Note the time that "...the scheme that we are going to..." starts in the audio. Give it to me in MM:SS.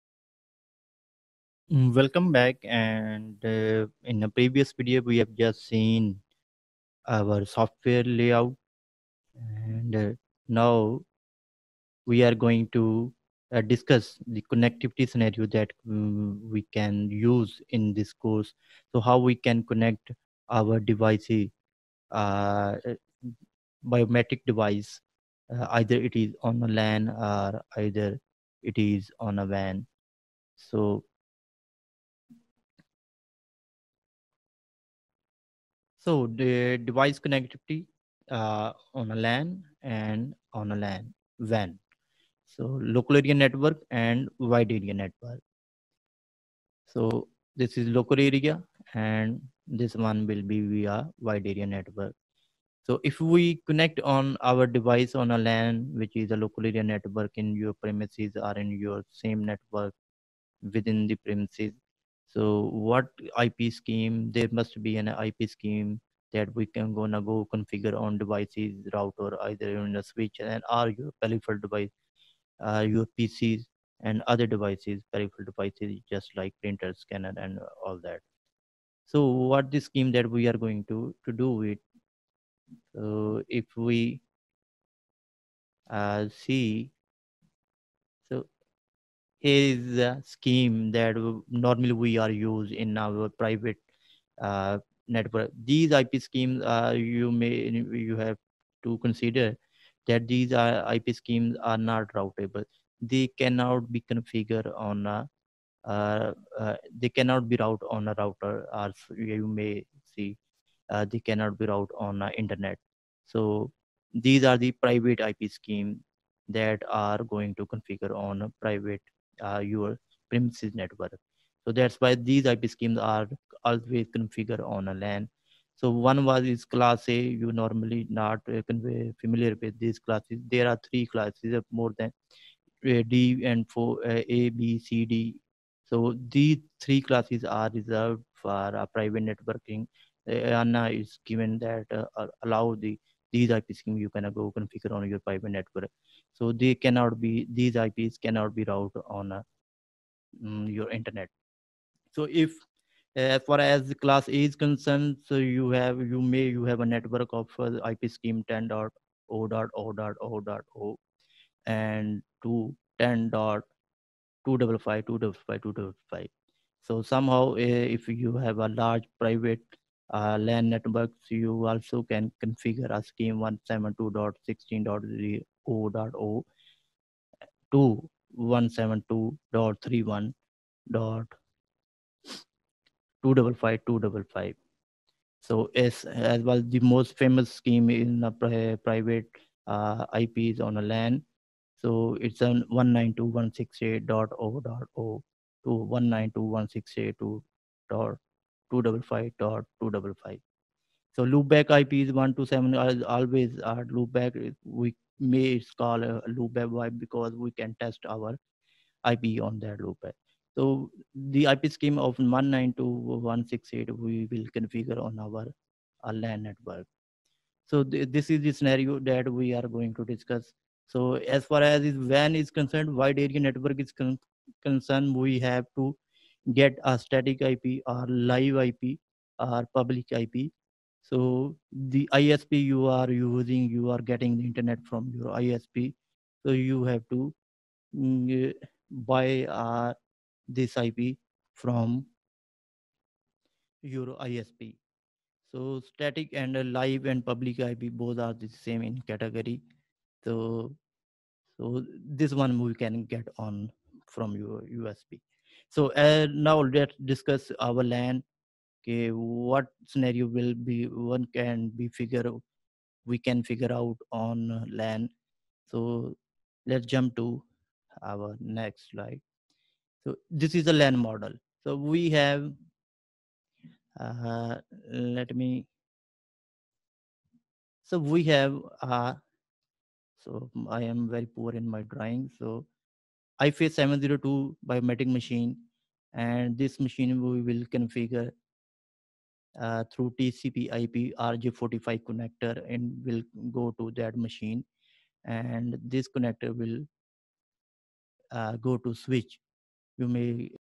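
01:19.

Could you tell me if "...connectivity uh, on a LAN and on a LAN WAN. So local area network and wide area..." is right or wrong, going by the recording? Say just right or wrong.
right.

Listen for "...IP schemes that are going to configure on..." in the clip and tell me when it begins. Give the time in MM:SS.
01:55.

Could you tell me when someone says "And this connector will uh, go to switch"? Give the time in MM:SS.
04:55.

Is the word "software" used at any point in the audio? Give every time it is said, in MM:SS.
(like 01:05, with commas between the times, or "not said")
00:07.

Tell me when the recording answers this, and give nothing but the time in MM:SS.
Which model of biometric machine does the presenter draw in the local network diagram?
04:43.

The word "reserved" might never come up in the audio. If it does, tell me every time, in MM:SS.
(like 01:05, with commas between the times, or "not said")
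02:17.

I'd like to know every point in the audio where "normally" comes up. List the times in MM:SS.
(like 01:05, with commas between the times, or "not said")
01:31, 02:07.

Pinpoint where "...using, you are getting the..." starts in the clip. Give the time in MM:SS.
03:53.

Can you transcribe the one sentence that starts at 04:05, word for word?
So static and live and public IP both are the same in category.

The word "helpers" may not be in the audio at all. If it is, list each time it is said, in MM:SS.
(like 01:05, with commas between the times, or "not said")
not said.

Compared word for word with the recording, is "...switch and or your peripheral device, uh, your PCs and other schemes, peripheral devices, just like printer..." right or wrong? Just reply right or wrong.
wrong.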